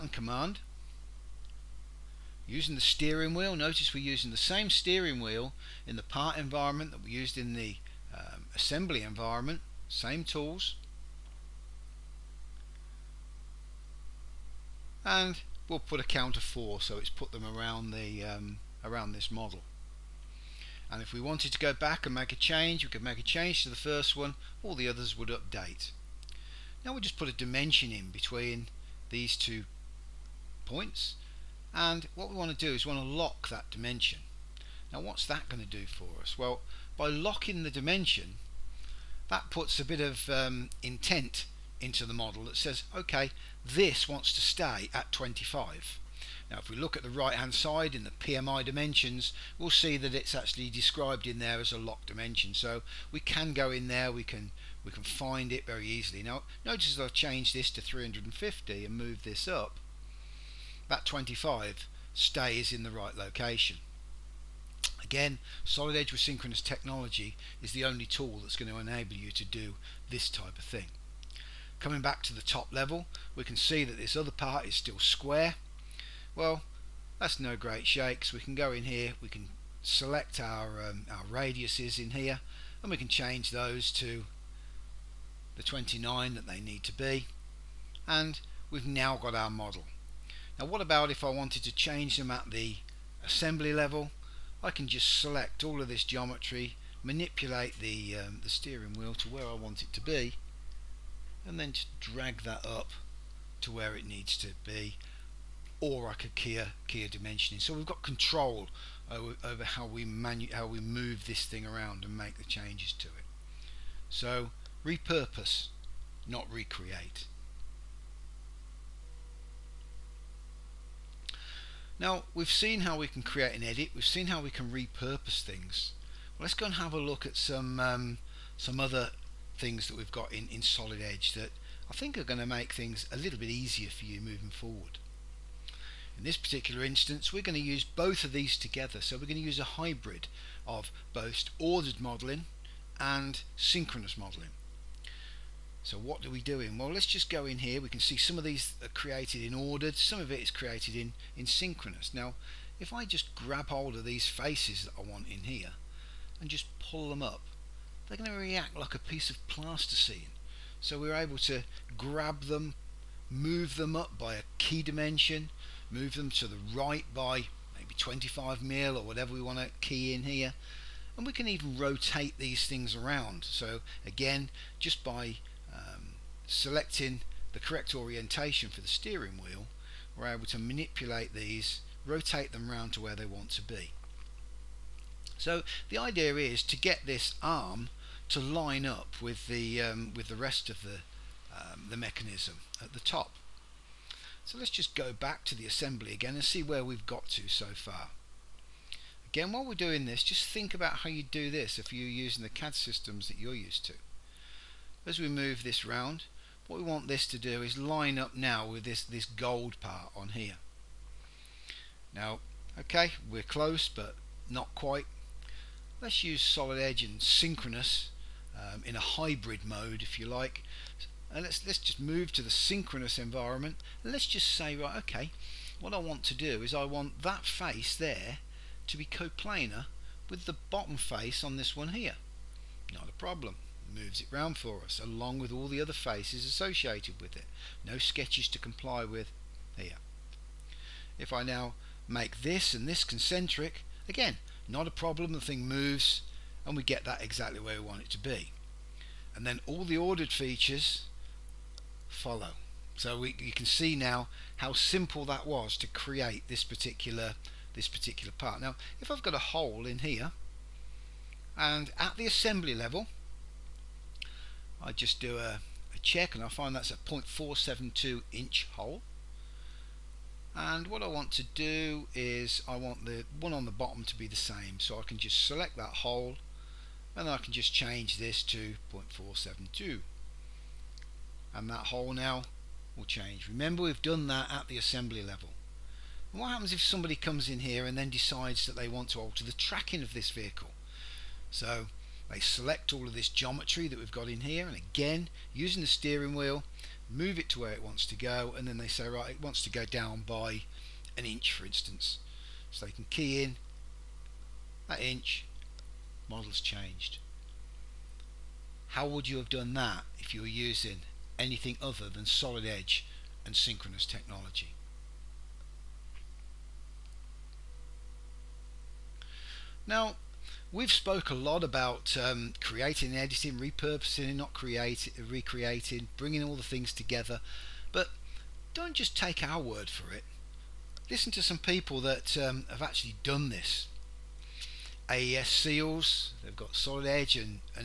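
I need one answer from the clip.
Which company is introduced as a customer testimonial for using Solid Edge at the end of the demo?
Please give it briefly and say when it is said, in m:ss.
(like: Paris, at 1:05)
AES Seals, at 5:35.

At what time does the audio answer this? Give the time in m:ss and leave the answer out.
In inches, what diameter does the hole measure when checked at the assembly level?
4:26.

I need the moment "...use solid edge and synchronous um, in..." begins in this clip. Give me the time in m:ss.
3:36.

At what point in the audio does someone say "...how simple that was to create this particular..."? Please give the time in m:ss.
4:14.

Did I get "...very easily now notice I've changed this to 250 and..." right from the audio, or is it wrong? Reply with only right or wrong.
wrong.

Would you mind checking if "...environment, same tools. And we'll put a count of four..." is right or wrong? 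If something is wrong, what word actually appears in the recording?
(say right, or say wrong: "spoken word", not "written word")
right.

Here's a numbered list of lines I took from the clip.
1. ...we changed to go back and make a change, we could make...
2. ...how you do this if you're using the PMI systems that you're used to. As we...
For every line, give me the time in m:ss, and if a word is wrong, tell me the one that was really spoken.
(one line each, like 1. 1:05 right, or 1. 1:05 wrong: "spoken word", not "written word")
1. 0:21 wrong: "wanted", not "changed"
2. 3:20 wrong: "CAD", not "PMI".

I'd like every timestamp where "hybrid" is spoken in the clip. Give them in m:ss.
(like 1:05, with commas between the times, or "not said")
2:19, 3:39.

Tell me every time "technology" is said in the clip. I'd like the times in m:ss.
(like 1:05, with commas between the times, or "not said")
1:06, 5:14.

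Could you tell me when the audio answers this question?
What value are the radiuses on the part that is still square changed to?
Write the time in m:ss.
1:25.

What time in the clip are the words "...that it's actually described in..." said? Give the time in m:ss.
0:49.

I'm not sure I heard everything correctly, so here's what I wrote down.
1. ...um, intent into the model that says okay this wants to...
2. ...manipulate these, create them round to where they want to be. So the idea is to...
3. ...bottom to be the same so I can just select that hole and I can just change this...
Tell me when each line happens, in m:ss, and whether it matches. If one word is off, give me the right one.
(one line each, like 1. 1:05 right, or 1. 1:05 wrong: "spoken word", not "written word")
1. 0:40 right
2. 3:00 wrong: "rotate", not "create"
3. 4:33 right.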